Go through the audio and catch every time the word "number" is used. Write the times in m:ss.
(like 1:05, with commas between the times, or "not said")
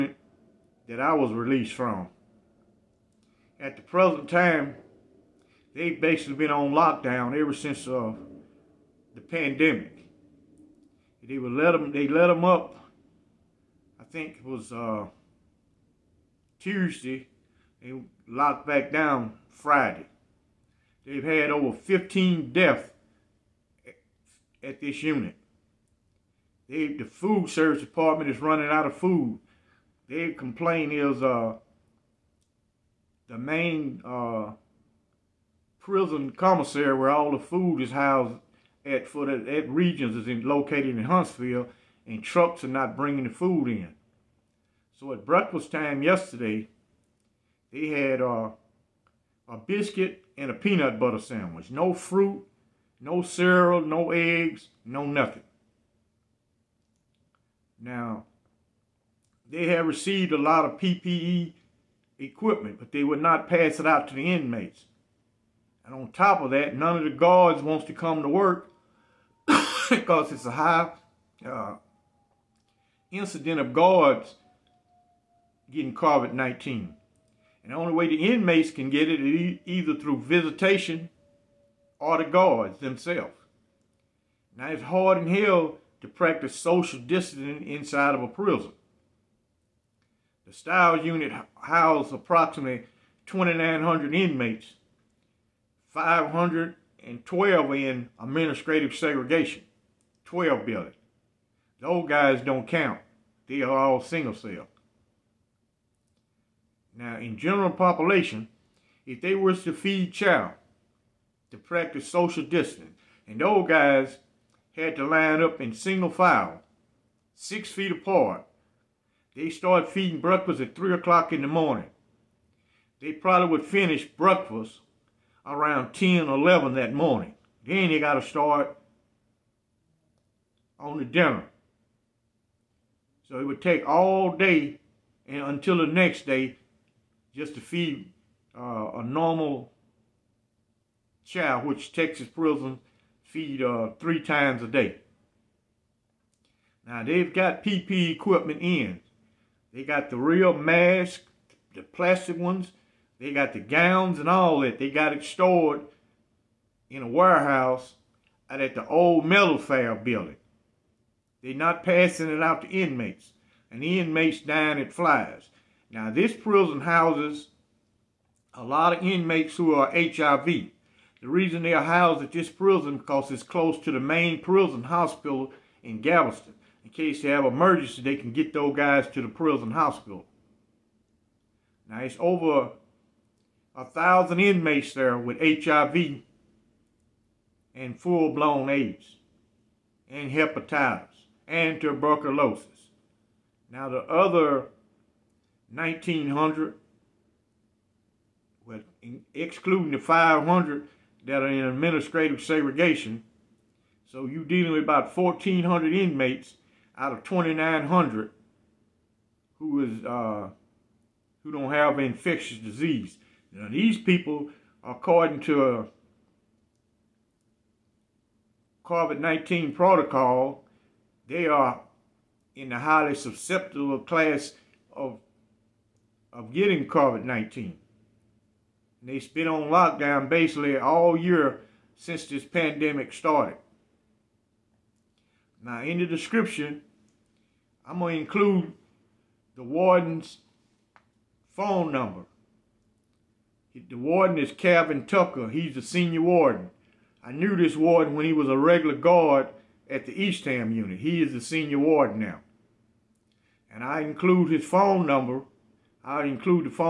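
4:01, 4:15.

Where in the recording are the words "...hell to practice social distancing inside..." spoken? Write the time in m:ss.
1:25.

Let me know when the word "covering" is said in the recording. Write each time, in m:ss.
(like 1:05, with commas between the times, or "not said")
not said.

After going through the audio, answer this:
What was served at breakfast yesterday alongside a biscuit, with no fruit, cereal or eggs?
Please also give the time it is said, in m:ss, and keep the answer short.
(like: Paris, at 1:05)
Peanut butter sandwich, at 0:50.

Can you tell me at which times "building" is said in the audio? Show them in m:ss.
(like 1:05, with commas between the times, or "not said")
1:40, 2:39.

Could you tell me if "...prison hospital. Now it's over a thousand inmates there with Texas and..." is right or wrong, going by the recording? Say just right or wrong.
wrong.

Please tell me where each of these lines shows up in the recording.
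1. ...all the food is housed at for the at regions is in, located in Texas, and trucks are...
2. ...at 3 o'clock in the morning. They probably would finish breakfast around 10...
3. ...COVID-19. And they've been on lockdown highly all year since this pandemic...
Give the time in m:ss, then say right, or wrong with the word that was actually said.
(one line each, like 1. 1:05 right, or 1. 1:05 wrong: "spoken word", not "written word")
1. 0:37 wrong: "Huntsville", not "Texas"
2. 2:00 right
3. 3:46 wrong: "basically", not "highly".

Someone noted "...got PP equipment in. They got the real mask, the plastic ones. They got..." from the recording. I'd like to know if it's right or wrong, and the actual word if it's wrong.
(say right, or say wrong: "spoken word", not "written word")
right.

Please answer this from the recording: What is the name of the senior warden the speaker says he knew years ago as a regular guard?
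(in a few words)
Calvin Tucker.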